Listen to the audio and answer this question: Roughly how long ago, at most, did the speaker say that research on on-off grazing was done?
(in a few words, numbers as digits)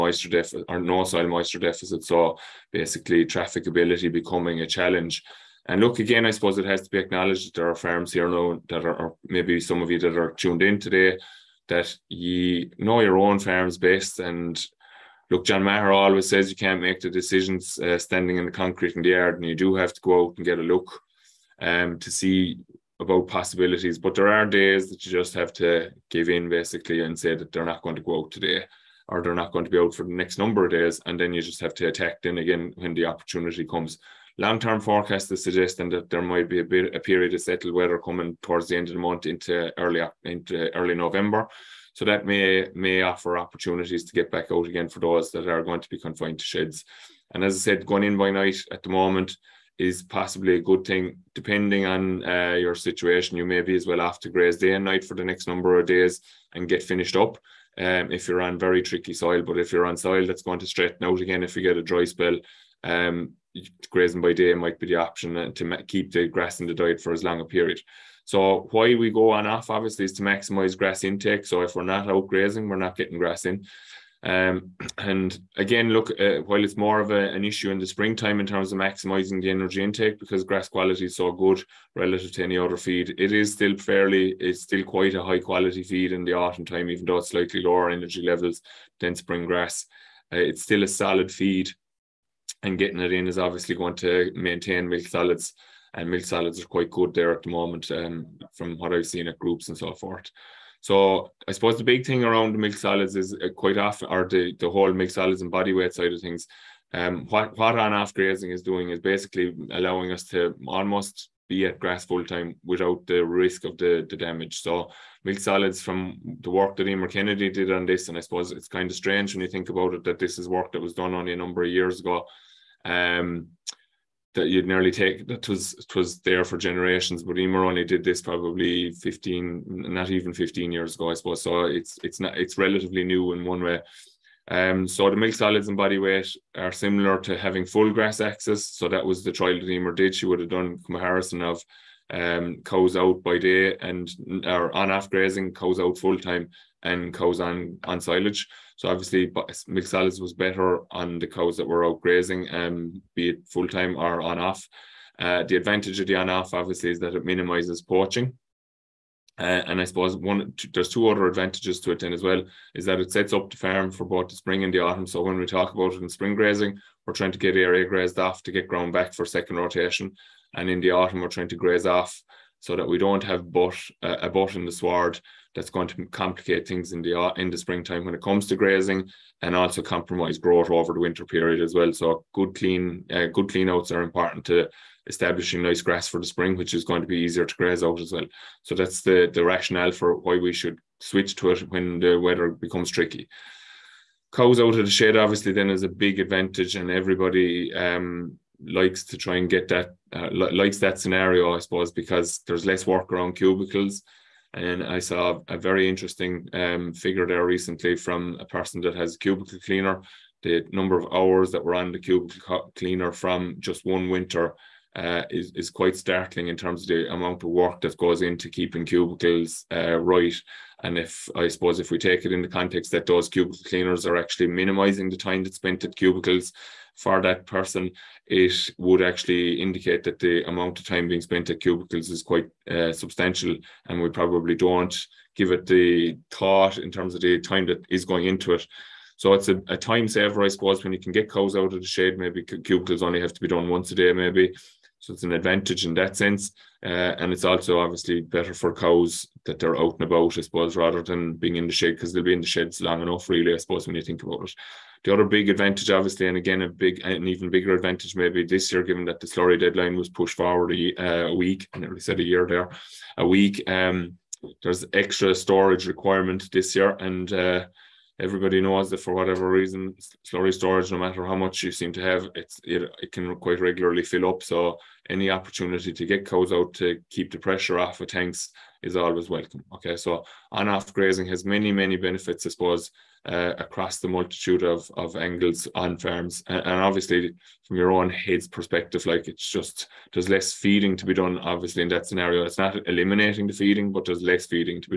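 15 years.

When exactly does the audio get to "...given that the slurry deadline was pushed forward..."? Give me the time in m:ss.
4:18.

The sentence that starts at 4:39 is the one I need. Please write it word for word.
Okay, so on off grazing has many, many benefits, I suppose, uh, across the multitude of, of angles on farms.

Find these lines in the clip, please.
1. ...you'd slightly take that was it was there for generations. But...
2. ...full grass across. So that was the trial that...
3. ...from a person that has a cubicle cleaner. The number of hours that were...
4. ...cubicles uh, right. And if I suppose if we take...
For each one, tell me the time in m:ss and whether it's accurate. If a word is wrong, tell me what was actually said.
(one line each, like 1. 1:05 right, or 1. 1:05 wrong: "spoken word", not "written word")
1. 2:04 wrong: "nearly", not "slightly"
2. 2:17 wrong: "access", not "across"
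3. 3:27 right
4. 3:38 right.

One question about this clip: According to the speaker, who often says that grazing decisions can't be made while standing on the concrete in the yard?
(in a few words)
John Maher.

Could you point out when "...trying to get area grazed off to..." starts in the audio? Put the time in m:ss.
2:47.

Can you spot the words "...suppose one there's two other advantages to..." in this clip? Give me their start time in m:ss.
2:39.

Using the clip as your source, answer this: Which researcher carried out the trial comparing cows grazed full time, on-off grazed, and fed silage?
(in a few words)
Emer Kennedy.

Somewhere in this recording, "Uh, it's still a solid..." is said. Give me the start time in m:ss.
1:30.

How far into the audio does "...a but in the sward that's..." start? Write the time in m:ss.
2:54.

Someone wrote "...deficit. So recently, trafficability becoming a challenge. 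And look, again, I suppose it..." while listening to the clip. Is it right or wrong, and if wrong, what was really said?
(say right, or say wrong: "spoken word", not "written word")
wrong: "basically", not "recently".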